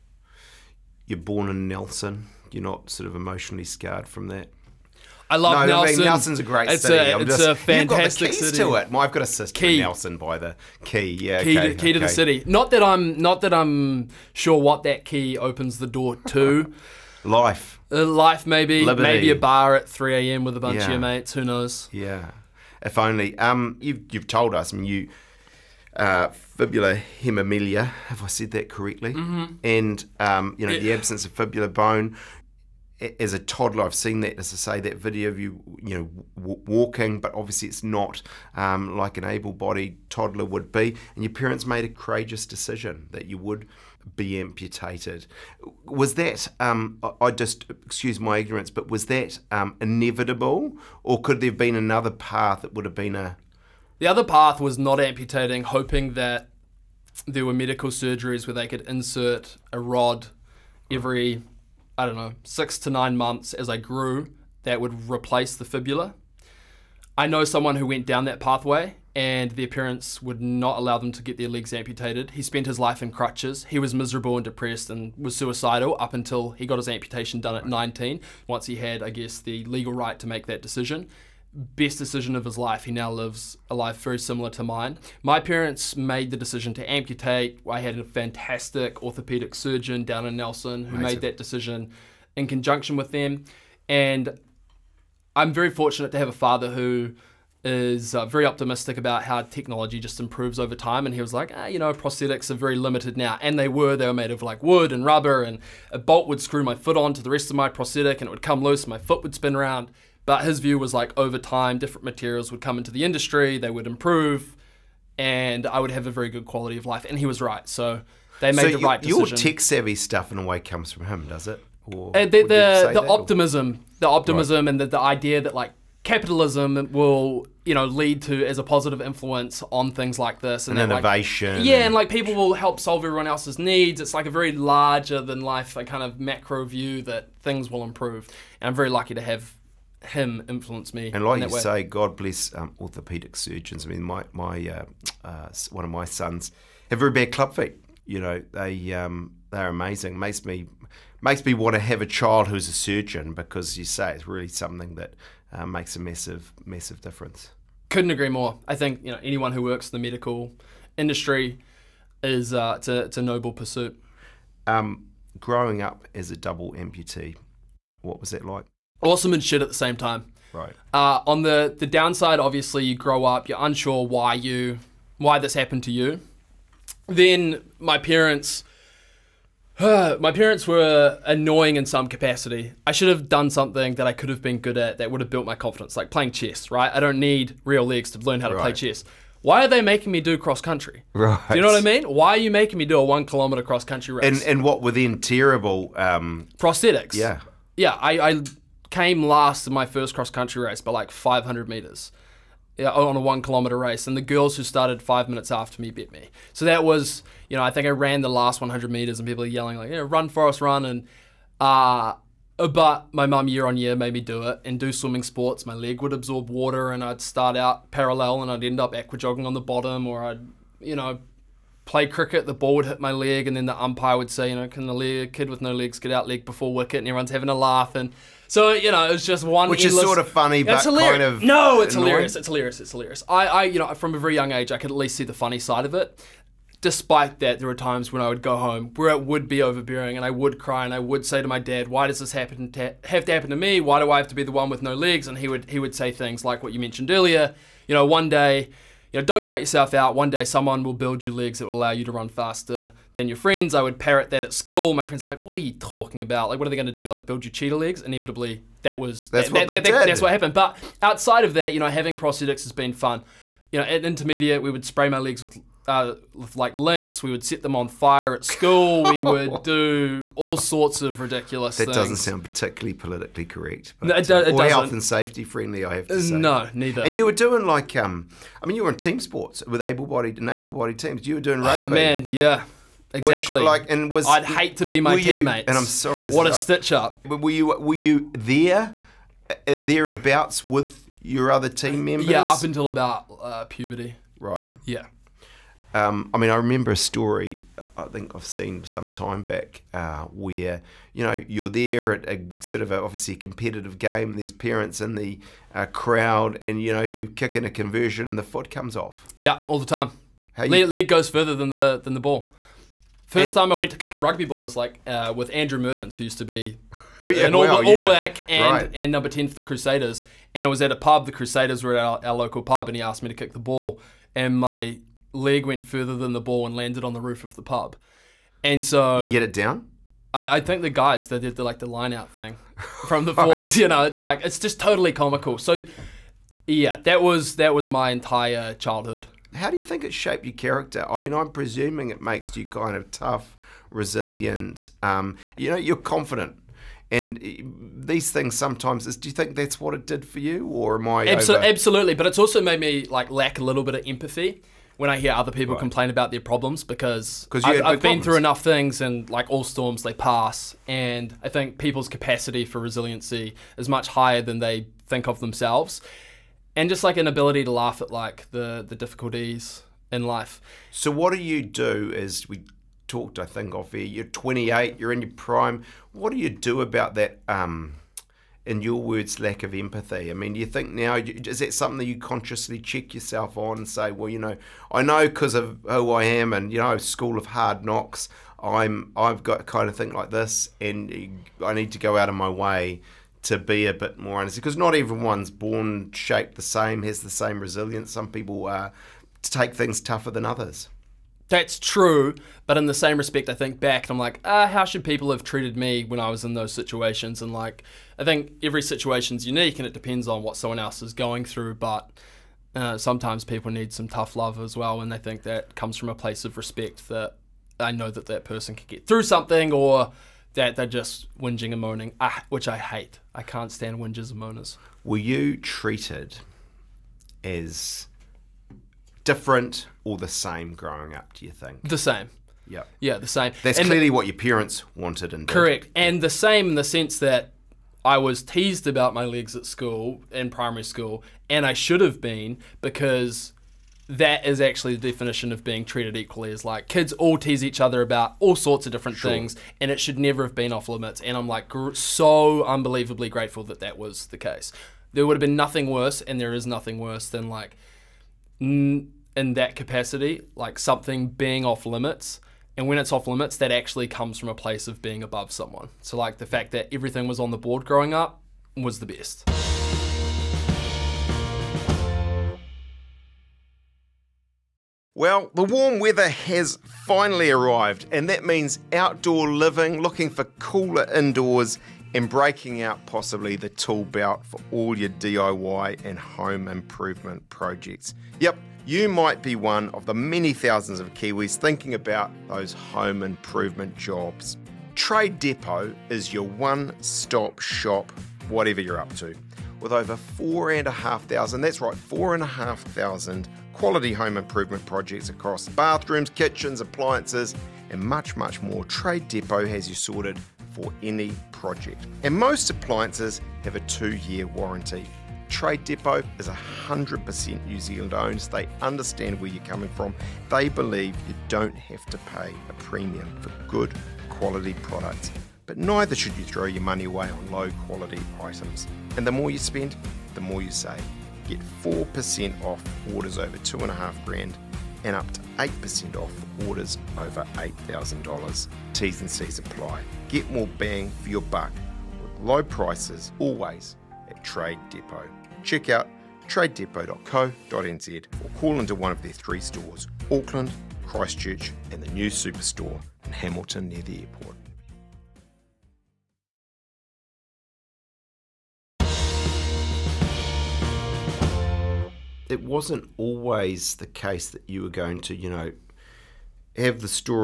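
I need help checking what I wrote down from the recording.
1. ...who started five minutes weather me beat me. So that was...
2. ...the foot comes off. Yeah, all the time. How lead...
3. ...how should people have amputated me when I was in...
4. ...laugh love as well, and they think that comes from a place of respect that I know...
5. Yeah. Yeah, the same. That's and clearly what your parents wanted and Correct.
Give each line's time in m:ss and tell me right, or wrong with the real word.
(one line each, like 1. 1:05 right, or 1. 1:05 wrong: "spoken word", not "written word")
1. 3:24 wrong: "after", not "weather"
2. 5:08 right
3. 6:44 wrong: "treated", not "amputated"
4. 6:54 wrong: "tough", not "laugh"
5. 7:12 right.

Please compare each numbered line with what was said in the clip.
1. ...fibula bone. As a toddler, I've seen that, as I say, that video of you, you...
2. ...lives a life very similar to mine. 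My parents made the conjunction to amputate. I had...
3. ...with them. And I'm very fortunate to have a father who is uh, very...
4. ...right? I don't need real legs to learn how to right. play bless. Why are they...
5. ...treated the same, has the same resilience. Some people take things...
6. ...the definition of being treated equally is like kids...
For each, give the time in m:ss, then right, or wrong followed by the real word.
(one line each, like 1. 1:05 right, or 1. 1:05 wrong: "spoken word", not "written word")
1. 0:31 right
2. 1:23 wrong: "decision", not "conjunction"
3. 1:32 right
4. 3:06 wrong: "chess", not "bless"
5. 6:36 wrong: "shaped", not "treated"
6. 7:24 right.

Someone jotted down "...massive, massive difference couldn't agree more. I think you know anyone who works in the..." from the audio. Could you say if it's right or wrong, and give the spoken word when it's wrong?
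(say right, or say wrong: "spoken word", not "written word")
right.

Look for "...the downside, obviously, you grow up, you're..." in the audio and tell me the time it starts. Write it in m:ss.
2:51.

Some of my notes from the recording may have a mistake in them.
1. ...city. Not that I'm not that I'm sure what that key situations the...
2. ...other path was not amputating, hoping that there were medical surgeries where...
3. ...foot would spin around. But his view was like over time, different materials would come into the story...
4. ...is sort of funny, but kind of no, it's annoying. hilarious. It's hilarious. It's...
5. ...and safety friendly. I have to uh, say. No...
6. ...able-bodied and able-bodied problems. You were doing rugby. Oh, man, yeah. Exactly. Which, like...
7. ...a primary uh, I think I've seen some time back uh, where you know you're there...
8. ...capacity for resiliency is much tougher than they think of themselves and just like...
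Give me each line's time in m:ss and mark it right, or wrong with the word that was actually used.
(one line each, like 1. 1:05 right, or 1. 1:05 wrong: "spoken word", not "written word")
1. 0:12 wrong: "opens", not "situations"
2. 0:54 right
3. 1:48 wrong: "industry", not "story"
4. 3:50 right
5. 4:34 right
6. 4:39 wrong: "teams", not "problems"
7. 4:56 wrong: "story", not "primary"
8. 6:02 wrong: "higher", not "tougher".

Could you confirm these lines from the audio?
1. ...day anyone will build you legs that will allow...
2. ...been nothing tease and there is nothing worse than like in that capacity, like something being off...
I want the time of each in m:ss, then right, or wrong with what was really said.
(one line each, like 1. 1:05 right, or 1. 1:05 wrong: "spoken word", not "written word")
1. 4:10 wrong: "someone", not "anyone"
2. 7:35 wrong: "worse", not "tease".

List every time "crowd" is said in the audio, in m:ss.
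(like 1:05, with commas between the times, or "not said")
5:05.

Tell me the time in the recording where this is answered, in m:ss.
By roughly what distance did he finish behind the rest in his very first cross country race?
3:21.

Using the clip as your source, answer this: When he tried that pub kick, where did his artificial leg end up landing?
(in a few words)
The roof of the pub.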